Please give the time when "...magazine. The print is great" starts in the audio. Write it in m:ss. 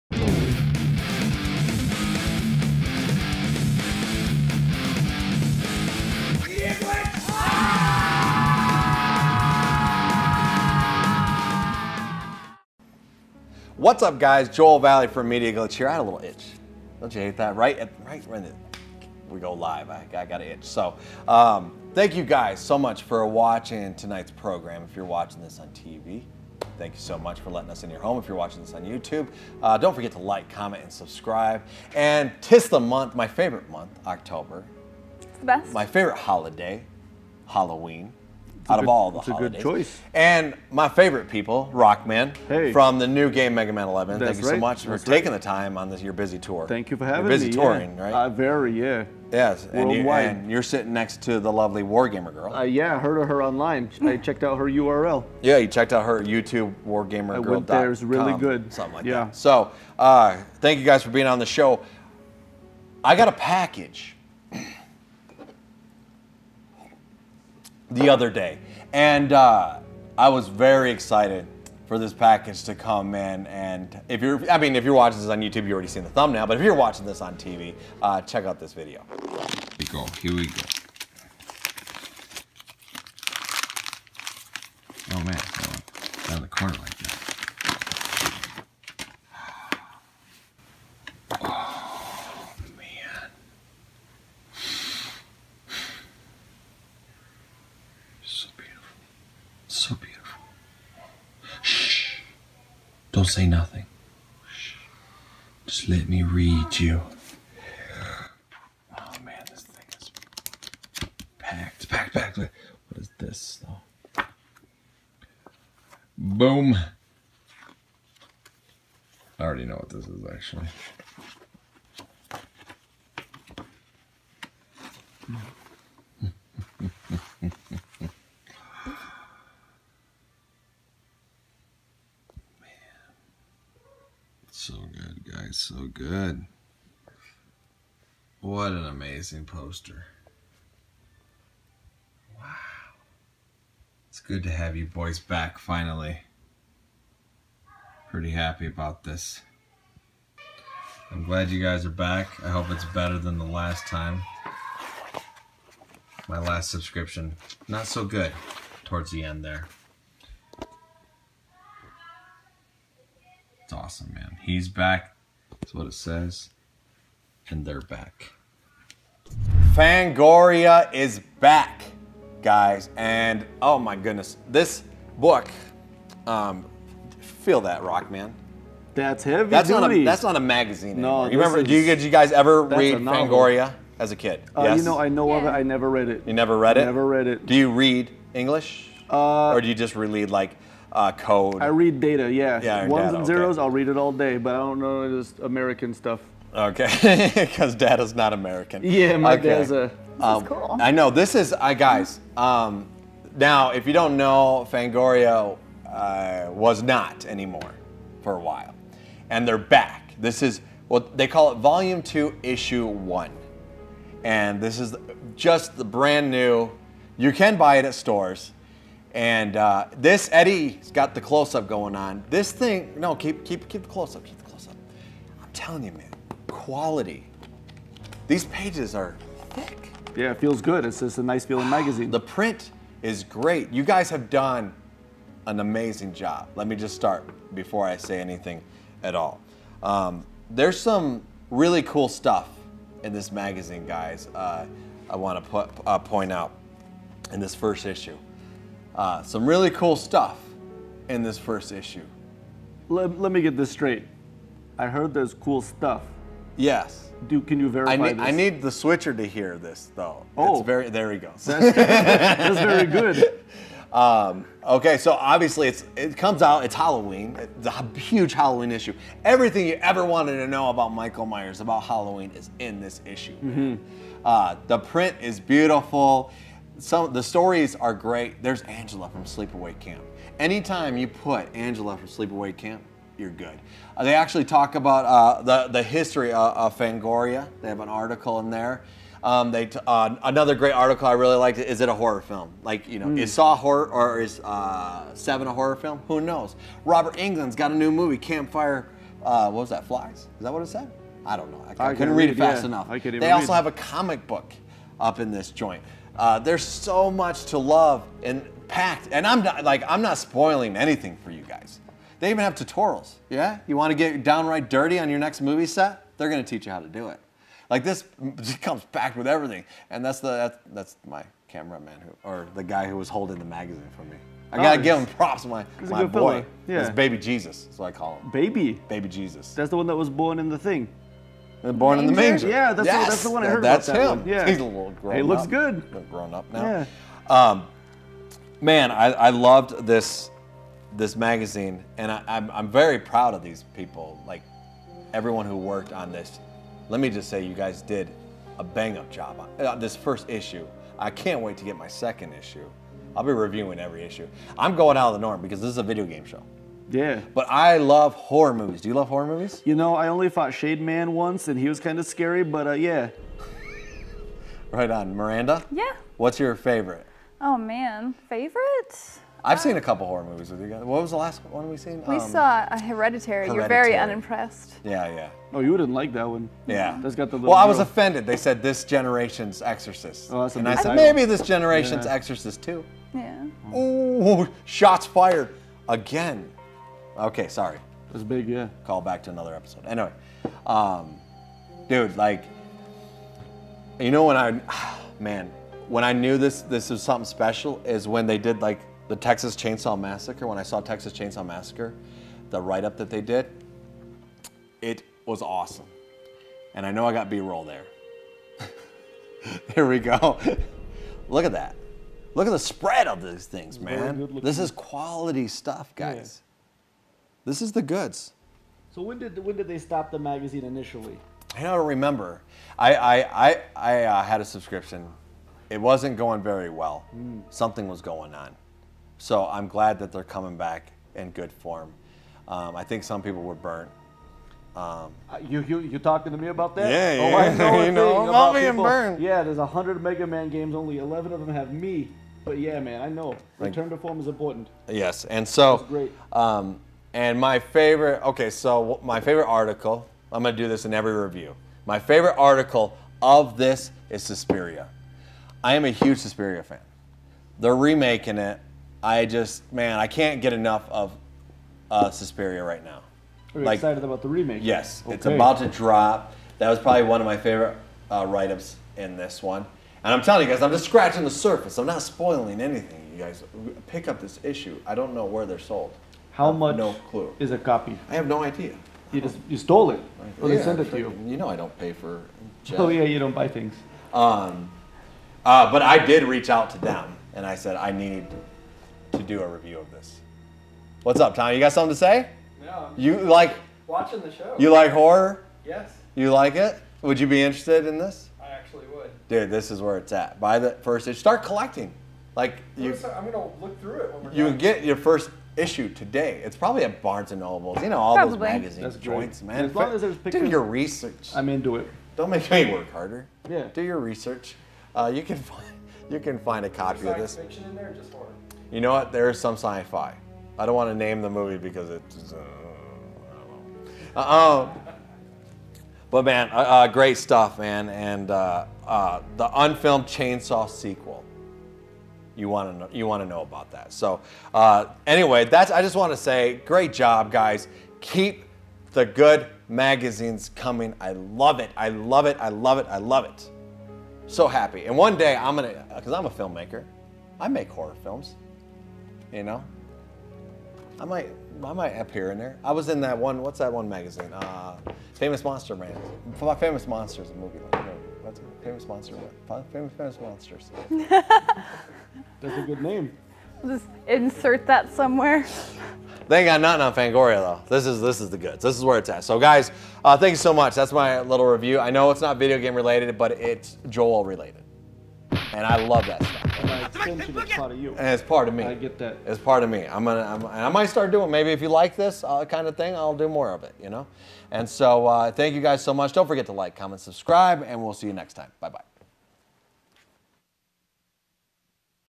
3:51.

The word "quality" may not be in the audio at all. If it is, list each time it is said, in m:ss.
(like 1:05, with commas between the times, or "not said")
3:46, 6:54.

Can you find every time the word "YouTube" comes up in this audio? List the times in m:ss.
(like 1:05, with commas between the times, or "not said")
0:28, 0:56, 1:15.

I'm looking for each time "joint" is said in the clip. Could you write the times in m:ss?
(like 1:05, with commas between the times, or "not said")
5:05, 8:29.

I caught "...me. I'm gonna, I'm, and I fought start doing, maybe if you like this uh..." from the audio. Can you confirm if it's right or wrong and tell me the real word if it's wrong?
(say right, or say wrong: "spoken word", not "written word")
wrong: "might", not "fought".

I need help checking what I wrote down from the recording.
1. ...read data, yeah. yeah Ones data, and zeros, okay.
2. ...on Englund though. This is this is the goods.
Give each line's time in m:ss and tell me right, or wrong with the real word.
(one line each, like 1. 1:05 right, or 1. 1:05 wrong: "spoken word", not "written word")
1. 3:11 right
2. 9:27 wrong: "Fangoria", not "Englund".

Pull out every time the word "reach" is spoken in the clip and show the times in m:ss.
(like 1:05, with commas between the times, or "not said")
8:06.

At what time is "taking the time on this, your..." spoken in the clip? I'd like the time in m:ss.
0:45.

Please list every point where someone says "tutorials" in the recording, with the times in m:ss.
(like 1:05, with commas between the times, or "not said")
5:12.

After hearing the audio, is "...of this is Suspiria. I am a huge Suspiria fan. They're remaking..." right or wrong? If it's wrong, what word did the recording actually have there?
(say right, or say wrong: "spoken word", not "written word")
right.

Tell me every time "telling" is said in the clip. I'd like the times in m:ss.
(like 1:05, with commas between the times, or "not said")
3:45, 7:50.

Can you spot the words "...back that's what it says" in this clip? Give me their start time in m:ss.
2:44.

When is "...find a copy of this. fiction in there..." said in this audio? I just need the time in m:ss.
8:36.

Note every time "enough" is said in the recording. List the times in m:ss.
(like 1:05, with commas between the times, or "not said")
5:02, 7:40.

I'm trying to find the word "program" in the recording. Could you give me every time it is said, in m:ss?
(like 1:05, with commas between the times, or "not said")
0:24.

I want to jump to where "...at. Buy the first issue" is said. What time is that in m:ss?
8:20.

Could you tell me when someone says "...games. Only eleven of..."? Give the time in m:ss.
7:20.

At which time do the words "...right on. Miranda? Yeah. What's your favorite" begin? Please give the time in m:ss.
6:04.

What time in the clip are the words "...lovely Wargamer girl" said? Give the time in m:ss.
0:51.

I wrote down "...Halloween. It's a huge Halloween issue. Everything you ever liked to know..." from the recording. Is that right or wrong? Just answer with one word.
wrong.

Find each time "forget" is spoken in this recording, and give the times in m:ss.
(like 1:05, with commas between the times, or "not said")
0:29, 9:46.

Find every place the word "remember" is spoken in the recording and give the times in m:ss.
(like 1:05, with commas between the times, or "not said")
3:01, 7:01.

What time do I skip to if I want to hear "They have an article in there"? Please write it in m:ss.
4:47.